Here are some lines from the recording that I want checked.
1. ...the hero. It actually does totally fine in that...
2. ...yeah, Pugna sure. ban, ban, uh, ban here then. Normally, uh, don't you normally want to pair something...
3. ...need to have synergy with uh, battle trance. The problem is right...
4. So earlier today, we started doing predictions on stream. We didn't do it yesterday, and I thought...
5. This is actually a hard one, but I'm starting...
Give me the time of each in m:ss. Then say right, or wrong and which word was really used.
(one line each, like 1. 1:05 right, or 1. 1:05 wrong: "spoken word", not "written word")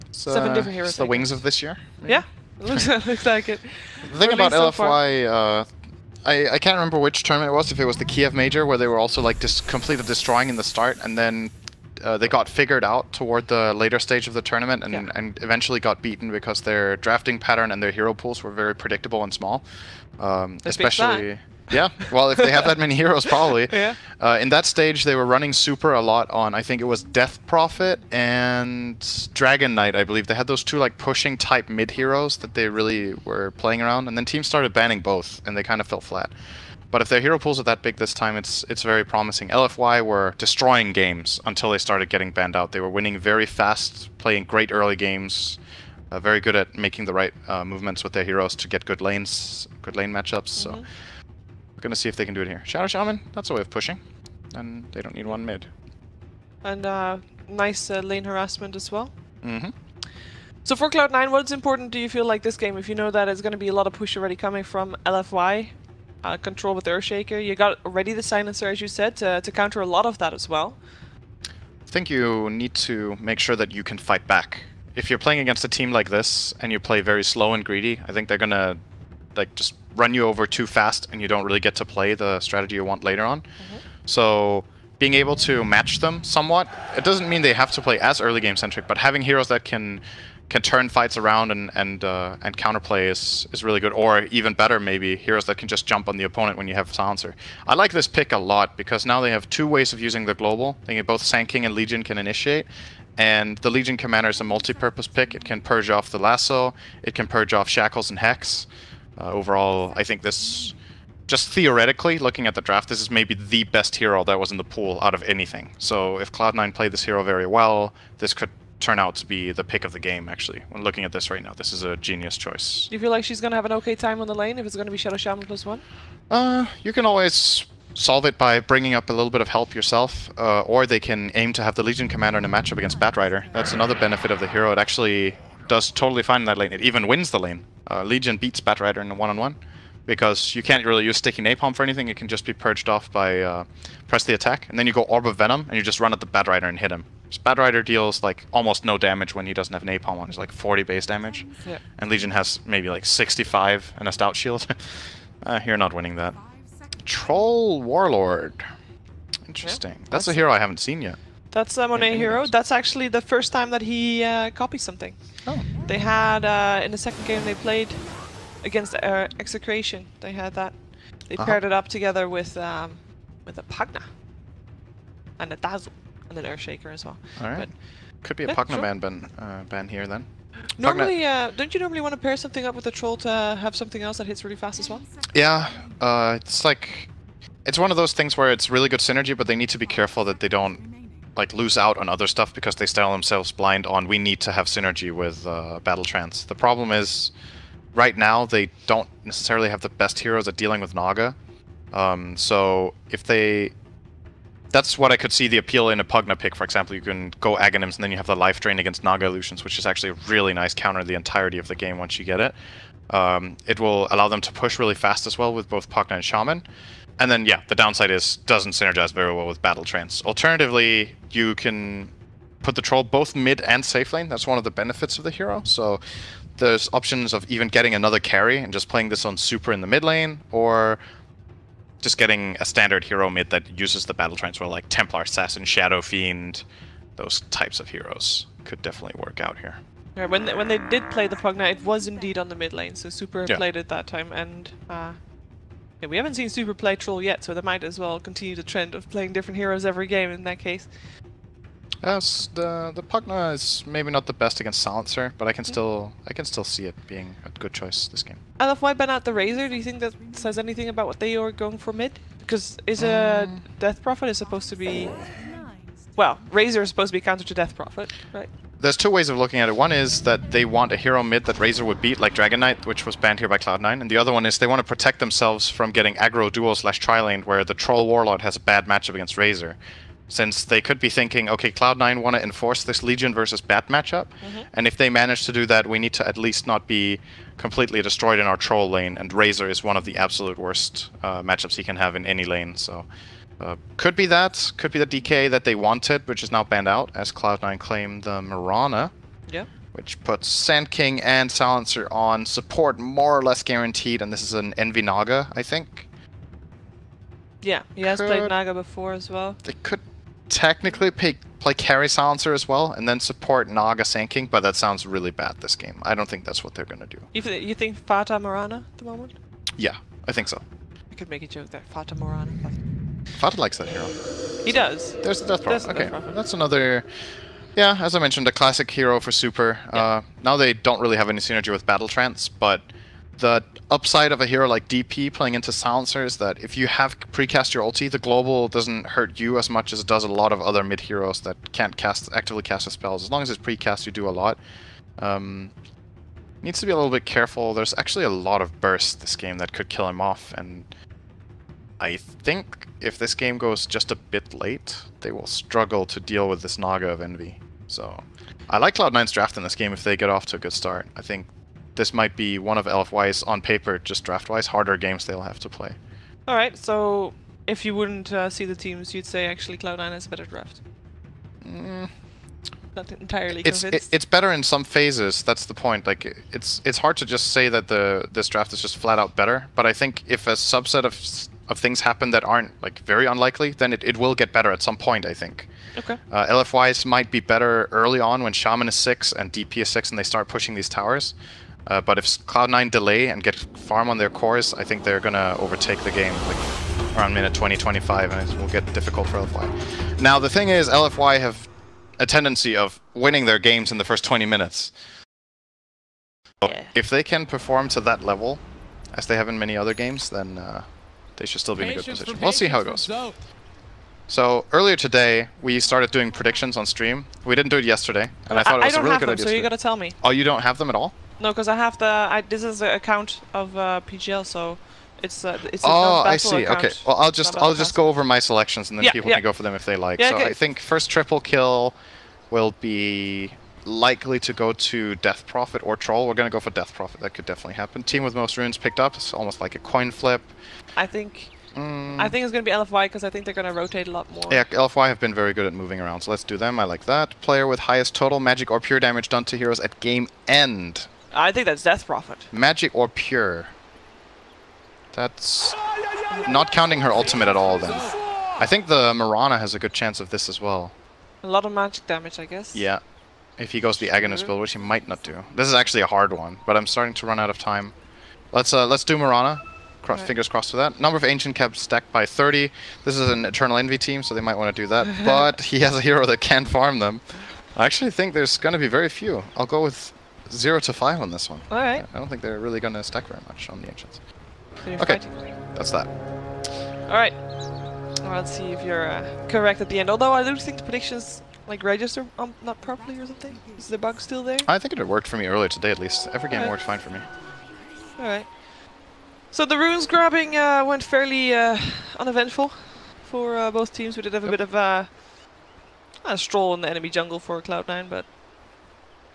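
1. 2:14 right
2. 2:58 right
3. 3:14 right
4. 6:54 right
5. 7:45 right.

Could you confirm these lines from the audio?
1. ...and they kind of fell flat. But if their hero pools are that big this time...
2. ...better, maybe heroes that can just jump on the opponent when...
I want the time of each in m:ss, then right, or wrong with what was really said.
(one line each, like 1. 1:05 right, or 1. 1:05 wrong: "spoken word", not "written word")
1. 0:35 right
2. 1:34 right.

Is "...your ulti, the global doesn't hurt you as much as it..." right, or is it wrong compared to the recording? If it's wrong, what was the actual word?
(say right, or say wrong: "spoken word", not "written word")
right.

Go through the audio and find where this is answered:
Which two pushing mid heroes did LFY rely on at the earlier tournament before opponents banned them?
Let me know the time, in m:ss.
0:27.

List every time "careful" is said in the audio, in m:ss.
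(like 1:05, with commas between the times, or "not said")
3:09, 5:47.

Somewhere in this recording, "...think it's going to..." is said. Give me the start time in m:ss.
7:22.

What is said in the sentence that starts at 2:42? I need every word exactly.
That's actually the first time that he uh, copies something.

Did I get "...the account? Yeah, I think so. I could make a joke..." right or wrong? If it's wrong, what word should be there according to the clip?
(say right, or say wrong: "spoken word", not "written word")
wrong: "moment", not "account".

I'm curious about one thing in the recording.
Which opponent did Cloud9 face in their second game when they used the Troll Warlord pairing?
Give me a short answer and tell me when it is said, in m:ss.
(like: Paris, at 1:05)
Execration, at 2:49.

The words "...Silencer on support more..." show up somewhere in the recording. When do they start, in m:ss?
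5:01.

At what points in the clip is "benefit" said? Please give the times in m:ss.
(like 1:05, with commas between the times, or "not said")
2:13, 3:44.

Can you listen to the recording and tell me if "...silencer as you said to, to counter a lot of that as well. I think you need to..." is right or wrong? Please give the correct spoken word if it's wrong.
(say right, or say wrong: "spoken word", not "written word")
right.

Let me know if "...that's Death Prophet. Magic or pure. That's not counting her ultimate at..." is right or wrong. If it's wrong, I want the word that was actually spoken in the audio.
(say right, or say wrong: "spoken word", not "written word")
right.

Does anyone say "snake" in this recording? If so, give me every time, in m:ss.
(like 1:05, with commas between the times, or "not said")
not said.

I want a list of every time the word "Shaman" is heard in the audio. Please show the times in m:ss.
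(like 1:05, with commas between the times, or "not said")
0:52, 2:05, 3:36, 6:28.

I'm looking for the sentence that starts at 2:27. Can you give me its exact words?
So Batrider deals like almost no damage when he doesn't have Napalm on.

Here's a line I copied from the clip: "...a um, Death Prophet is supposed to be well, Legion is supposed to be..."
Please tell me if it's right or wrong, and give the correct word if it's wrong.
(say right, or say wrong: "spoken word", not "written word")
wrong: "Razor", not "Legion".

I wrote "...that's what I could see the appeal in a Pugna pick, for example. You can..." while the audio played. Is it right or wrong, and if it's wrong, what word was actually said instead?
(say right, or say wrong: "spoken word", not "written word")
right.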